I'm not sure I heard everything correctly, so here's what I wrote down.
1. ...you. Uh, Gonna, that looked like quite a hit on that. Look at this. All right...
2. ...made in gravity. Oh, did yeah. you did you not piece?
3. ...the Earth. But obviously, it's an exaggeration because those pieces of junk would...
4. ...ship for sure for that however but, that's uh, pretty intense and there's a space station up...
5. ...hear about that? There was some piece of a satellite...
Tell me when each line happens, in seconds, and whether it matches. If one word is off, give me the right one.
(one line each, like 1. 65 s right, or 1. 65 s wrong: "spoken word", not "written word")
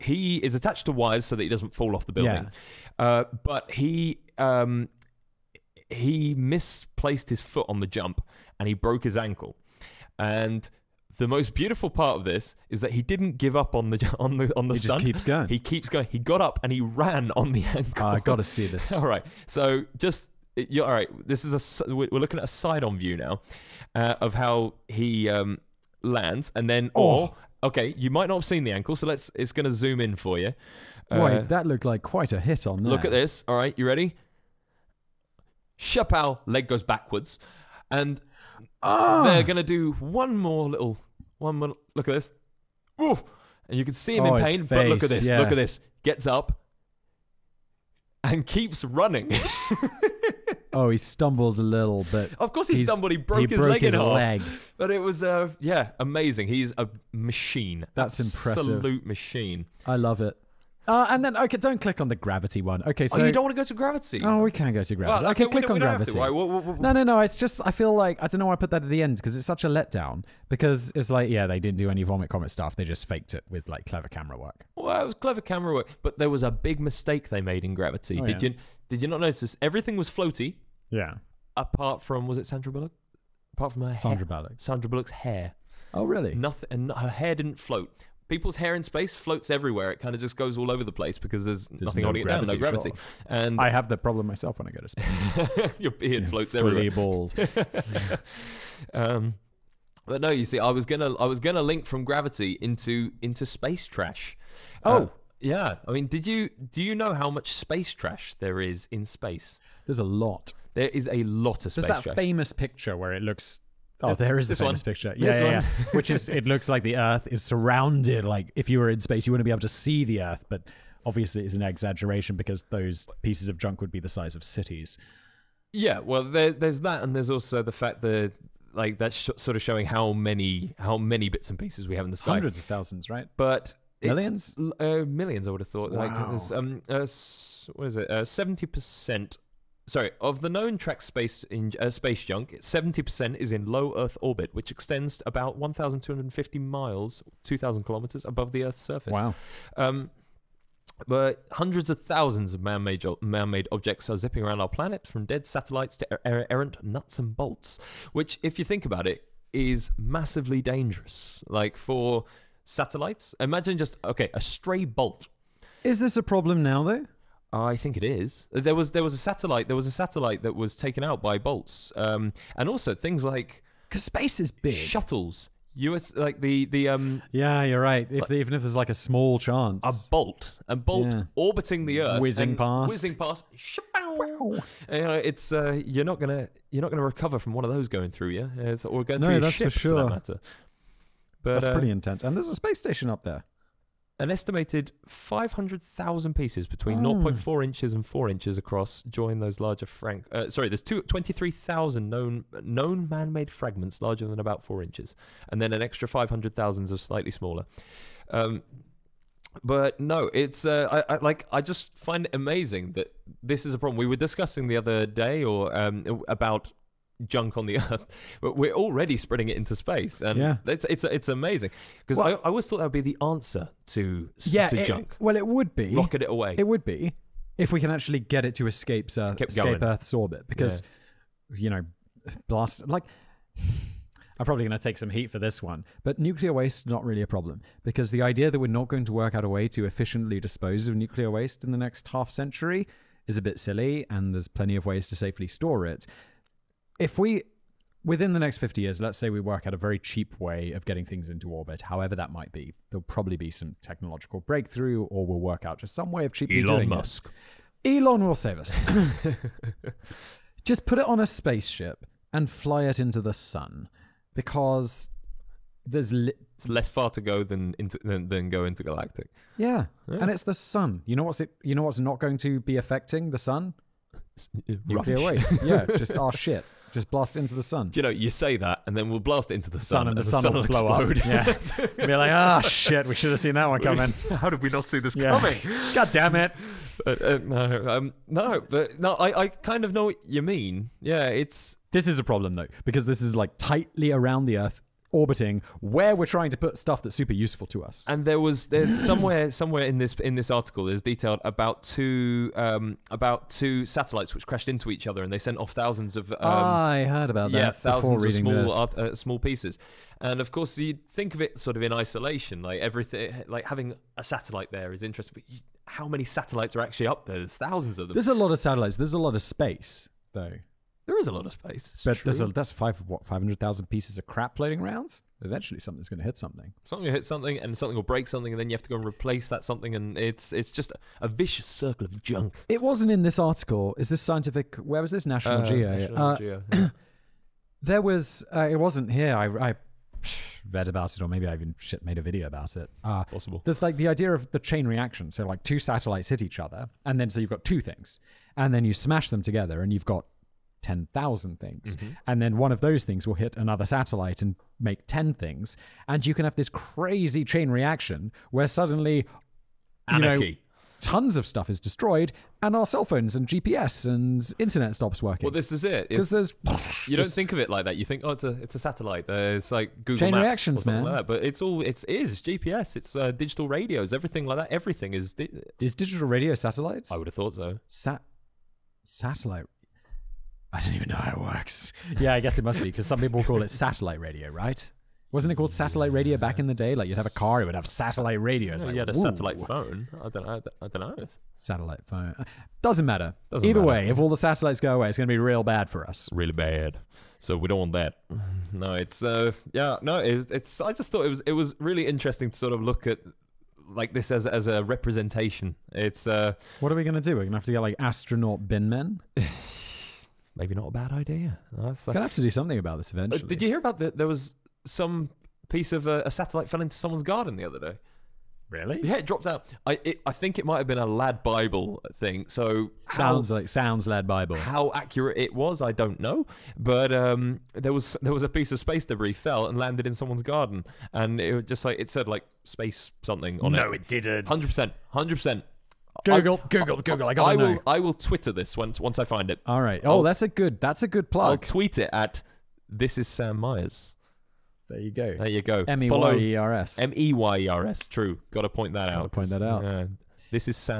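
1. 30 s wrong: "Wait", not "Gonna"
2. 77 s wrong: "notice", not "piece"
3. 120 s right
4. 189 s wrong: "matter", not "however"
5. 413 s right.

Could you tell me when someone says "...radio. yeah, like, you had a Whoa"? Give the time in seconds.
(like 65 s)
388 s.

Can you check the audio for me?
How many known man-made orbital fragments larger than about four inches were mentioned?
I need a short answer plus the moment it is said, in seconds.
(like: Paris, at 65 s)
23,000, at 200 s.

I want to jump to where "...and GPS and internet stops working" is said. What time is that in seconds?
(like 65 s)
363 s.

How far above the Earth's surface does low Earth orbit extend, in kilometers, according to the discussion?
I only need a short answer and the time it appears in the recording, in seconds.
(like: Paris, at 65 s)
2,000 kilometers, at 147 s.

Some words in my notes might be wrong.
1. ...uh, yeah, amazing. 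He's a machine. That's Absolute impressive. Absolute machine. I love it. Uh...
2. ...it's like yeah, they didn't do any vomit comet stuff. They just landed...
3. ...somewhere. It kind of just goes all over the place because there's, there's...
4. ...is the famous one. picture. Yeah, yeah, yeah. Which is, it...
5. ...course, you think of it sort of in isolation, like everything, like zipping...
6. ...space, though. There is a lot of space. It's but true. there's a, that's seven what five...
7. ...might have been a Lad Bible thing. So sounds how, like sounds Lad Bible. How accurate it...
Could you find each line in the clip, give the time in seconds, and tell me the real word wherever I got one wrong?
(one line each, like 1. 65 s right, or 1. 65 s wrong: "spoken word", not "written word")
1. 55 s right
2. 70 s wrong: "faked", not "landed"
3. 89 s wrong: "everywhere", not "somewhere"
4. 114 s right
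5. 310 s wrong: "having", not "zipping"
6. 319 s wrong: "five", not "seven"
7. 420 s right.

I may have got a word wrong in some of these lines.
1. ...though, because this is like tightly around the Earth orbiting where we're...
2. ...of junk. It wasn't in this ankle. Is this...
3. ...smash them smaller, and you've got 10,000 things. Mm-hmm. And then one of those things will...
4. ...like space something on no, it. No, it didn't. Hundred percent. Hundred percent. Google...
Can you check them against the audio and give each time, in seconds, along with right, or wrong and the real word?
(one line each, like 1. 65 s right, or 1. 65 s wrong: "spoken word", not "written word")
1. 292 s right
2. 332 s wrong: "article", not "ankle"
3. 348 s wrong: "together", not "smaller"
4. 432 s right.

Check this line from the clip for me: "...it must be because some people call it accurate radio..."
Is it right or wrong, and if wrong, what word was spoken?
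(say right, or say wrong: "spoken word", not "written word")
wrong: "satellite", not "accurate".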